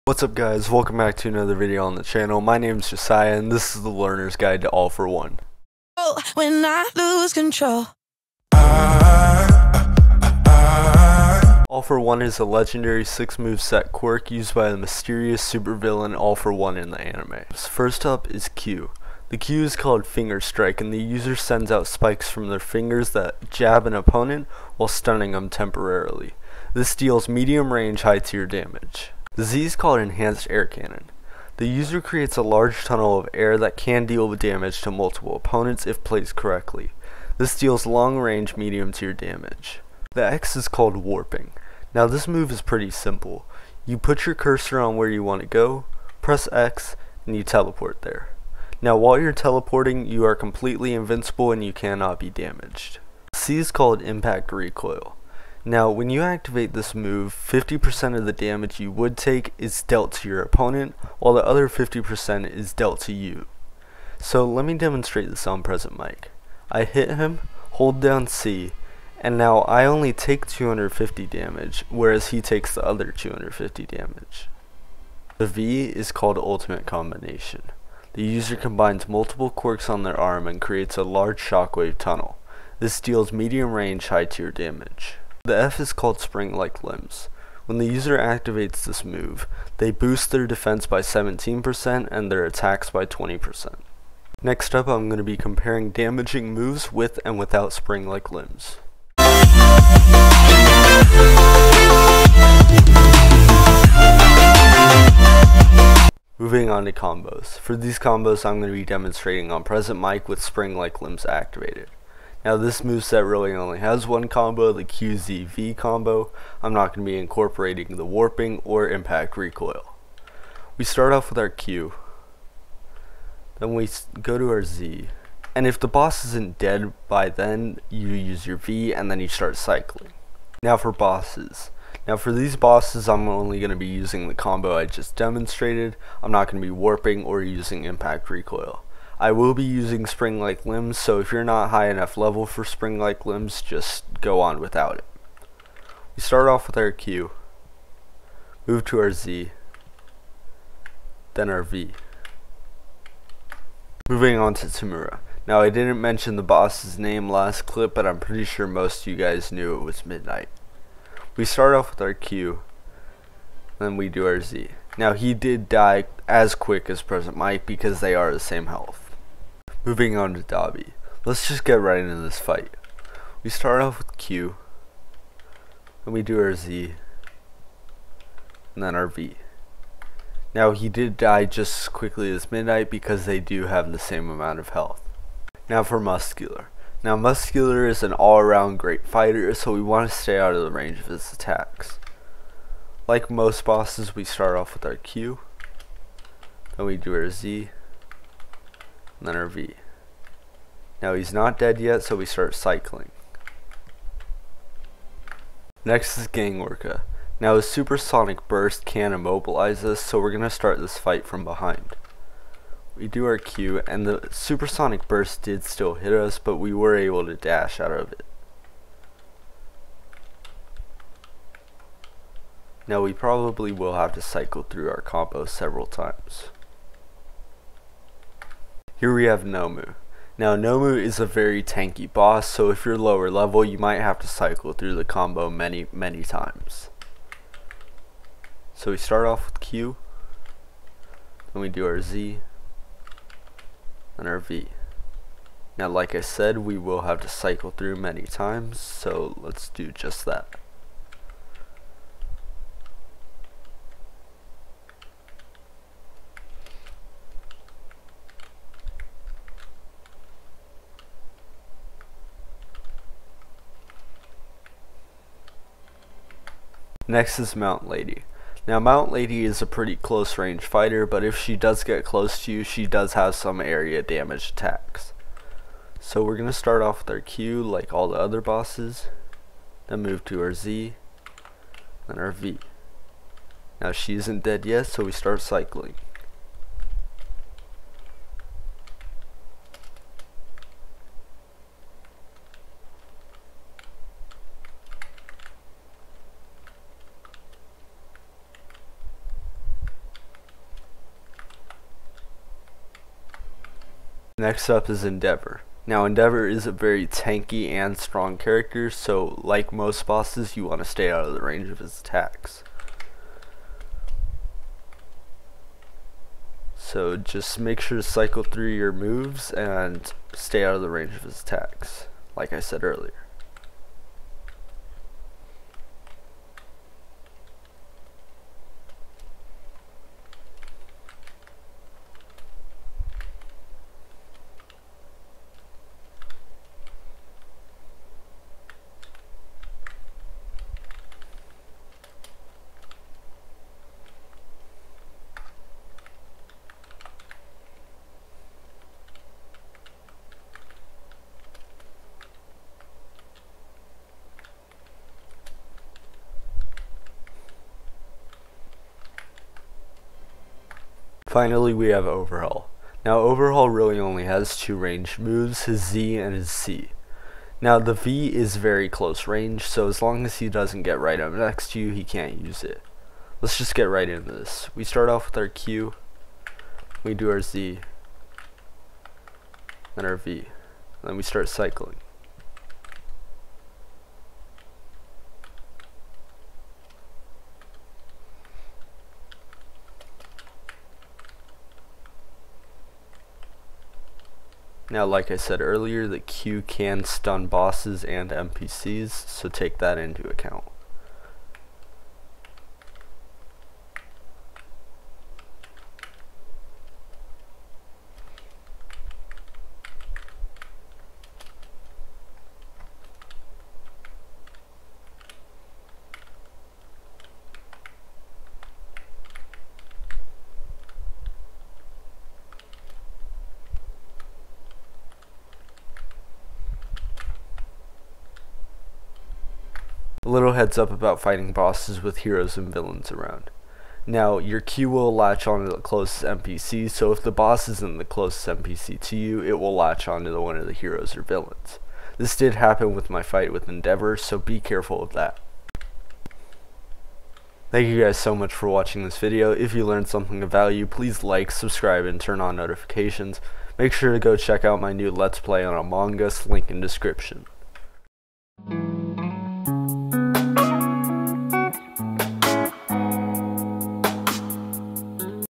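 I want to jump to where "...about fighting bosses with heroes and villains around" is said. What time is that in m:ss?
7:10.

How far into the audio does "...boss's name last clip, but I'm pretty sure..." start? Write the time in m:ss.
2:36.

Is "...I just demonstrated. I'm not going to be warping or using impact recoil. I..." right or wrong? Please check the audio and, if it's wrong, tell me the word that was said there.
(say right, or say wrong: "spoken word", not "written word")
right.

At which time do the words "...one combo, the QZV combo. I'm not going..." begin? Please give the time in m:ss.
1:54.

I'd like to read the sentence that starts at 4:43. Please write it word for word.
Now she isn't dead yet, so we start cycling.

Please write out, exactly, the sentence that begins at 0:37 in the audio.
This deals long range medium tier damage.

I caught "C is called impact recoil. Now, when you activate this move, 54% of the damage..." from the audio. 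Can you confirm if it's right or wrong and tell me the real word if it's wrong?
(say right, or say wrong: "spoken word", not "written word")
wrong: "50", not "54".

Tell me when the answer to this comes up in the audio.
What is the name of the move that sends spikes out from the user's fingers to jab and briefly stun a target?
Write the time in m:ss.
0:20.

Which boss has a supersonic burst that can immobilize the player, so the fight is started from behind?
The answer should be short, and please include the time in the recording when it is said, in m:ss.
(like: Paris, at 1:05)
Gang Orca, at 3:26.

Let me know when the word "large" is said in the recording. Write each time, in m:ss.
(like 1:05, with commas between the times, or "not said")
0:32, 1:21.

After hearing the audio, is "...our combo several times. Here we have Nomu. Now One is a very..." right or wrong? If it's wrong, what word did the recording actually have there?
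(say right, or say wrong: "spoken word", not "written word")
wrong: "Nomu", not "One".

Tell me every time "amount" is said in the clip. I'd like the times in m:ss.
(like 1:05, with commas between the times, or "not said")
3:04.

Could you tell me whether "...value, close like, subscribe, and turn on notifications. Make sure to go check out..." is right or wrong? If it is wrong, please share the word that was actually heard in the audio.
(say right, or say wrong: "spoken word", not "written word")
wrong: "please", not "close".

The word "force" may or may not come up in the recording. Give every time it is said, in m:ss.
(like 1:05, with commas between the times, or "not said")
not said.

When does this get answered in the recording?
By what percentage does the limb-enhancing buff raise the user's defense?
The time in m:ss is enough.
1:31.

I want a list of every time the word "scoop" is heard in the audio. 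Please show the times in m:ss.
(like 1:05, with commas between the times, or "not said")
not said.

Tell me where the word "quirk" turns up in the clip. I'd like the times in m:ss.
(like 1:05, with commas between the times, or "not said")
0:13, 1:19.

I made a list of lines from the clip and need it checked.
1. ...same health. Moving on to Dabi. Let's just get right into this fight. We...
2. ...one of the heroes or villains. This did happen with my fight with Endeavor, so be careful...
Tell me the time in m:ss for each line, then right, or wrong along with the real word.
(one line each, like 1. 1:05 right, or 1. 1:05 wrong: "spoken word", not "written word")
1. 2:48 right
2. 7:20 right.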